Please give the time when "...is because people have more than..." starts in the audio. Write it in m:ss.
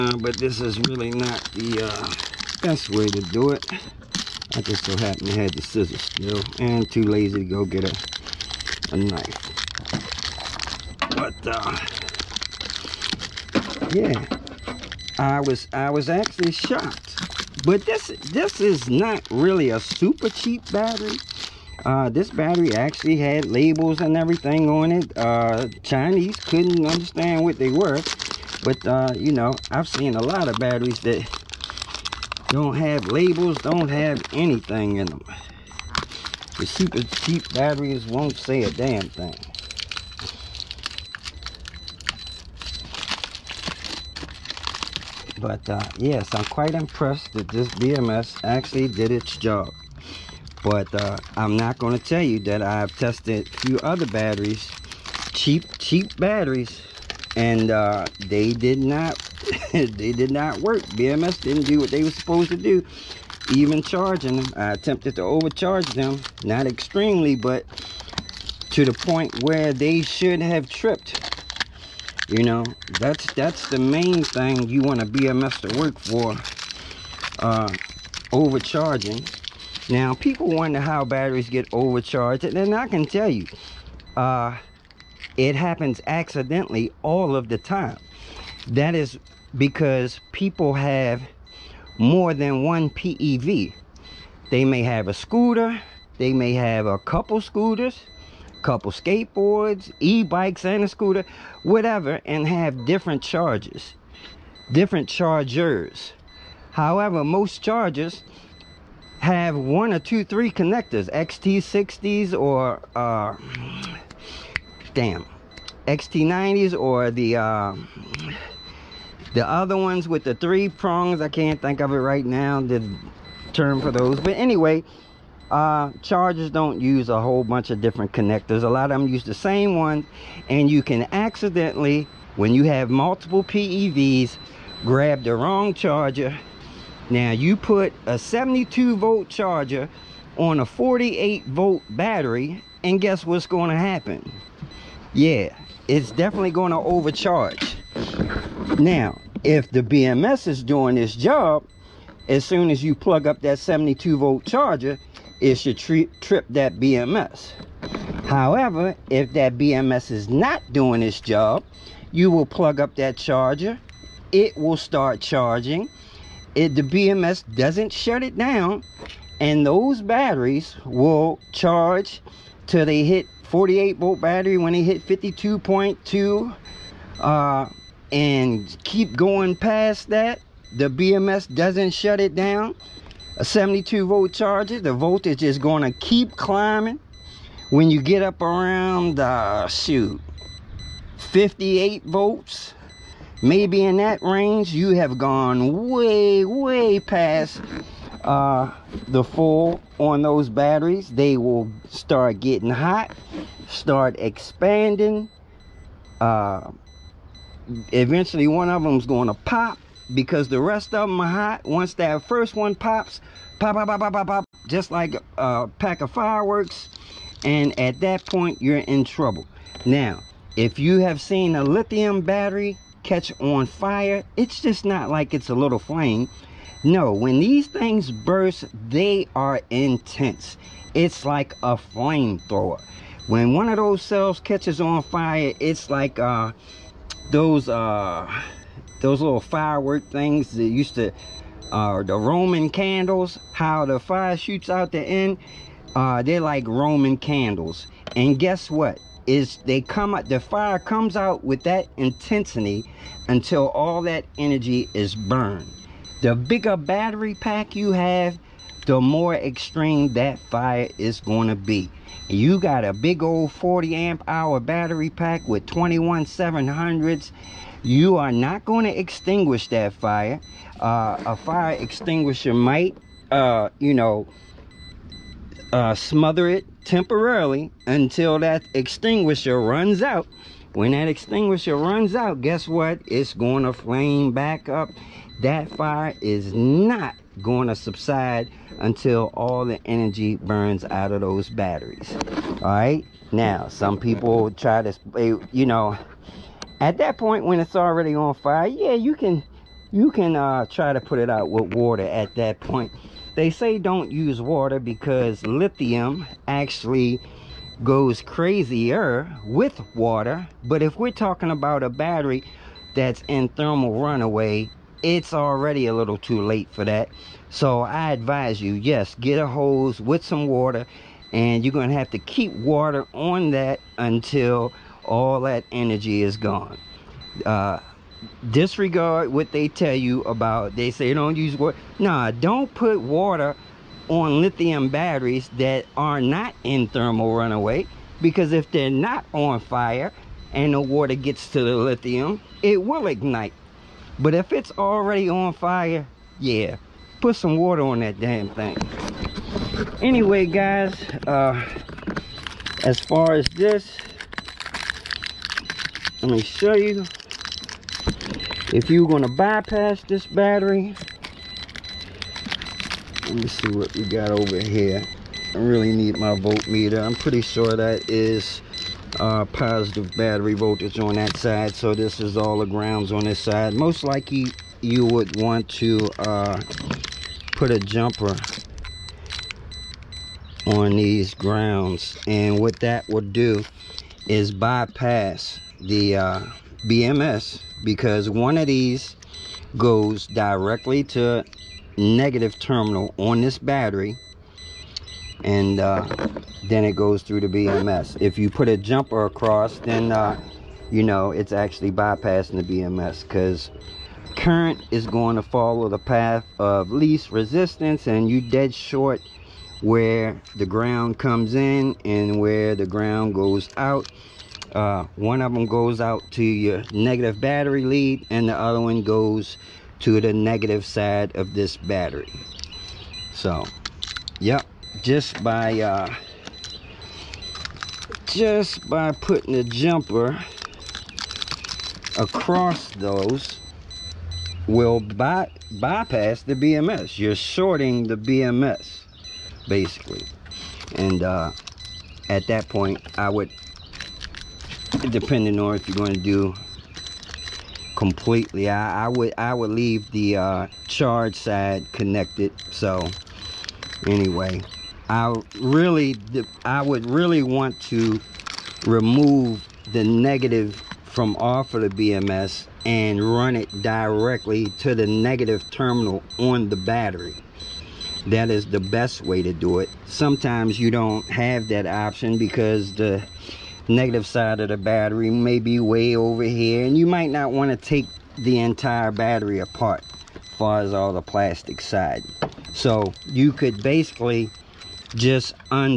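1:28.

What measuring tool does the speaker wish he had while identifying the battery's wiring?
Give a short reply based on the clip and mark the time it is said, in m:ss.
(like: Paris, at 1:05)
voltmeter, at 6:06.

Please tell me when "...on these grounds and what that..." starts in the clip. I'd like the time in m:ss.
6:20.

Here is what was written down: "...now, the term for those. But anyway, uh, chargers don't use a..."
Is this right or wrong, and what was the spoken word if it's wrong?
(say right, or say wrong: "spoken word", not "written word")
right.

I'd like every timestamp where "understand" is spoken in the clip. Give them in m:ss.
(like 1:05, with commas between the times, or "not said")
0:26.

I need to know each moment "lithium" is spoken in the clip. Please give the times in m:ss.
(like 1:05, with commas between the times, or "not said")
3:41, 5:05, 5:34, 5:41.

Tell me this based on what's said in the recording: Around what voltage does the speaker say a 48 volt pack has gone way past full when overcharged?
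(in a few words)
58 volts.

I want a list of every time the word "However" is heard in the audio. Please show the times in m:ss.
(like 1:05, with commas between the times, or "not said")
1:46, 2:38.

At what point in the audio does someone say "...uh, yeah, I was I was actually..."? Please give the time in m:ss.
0:11.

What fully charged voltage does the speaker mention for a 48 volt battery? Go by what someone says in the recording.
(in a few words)
52.2.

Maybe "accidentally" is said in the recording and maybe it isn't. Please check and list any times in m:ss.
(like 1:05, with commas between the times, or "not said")
1:26, 2:11.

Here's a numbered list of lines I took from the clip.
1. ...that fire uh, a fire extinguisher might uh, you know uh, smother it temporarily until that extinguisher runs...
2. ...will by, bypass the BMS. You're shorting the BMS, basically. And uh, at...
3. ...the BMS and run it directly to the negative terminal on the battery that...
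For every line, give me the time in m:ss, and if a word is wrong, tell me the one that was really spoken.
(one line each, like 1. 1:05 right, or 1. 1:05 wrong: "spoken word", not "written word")
1. 4:29 right
2. 7:14 right
3. 7:41 right.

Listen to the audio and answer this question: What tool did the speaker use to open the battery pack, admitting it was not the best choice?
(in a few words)
scissors.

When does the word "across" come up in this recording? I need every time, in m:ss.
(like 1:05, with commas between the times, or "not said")
6:39, 7:12.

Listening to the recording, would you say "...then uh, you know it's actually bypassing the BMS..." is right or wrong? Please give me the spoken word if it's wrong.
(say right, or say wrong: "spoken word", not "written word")
right.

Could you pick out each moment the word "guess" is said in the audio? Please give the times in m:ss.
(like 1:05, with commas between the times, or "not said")
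2:23, 4:08, 4:42.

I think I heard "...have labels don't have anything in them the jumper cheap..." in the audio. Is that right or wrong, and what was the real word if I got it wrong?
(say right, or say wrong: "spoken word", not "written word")
wrong: "super", not "jumper".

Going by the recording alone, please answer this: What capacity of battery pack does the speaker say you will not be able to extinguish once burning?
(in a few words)
40 amp hour.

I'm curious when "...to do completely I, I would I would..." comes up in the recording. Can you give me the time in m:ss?
7:26.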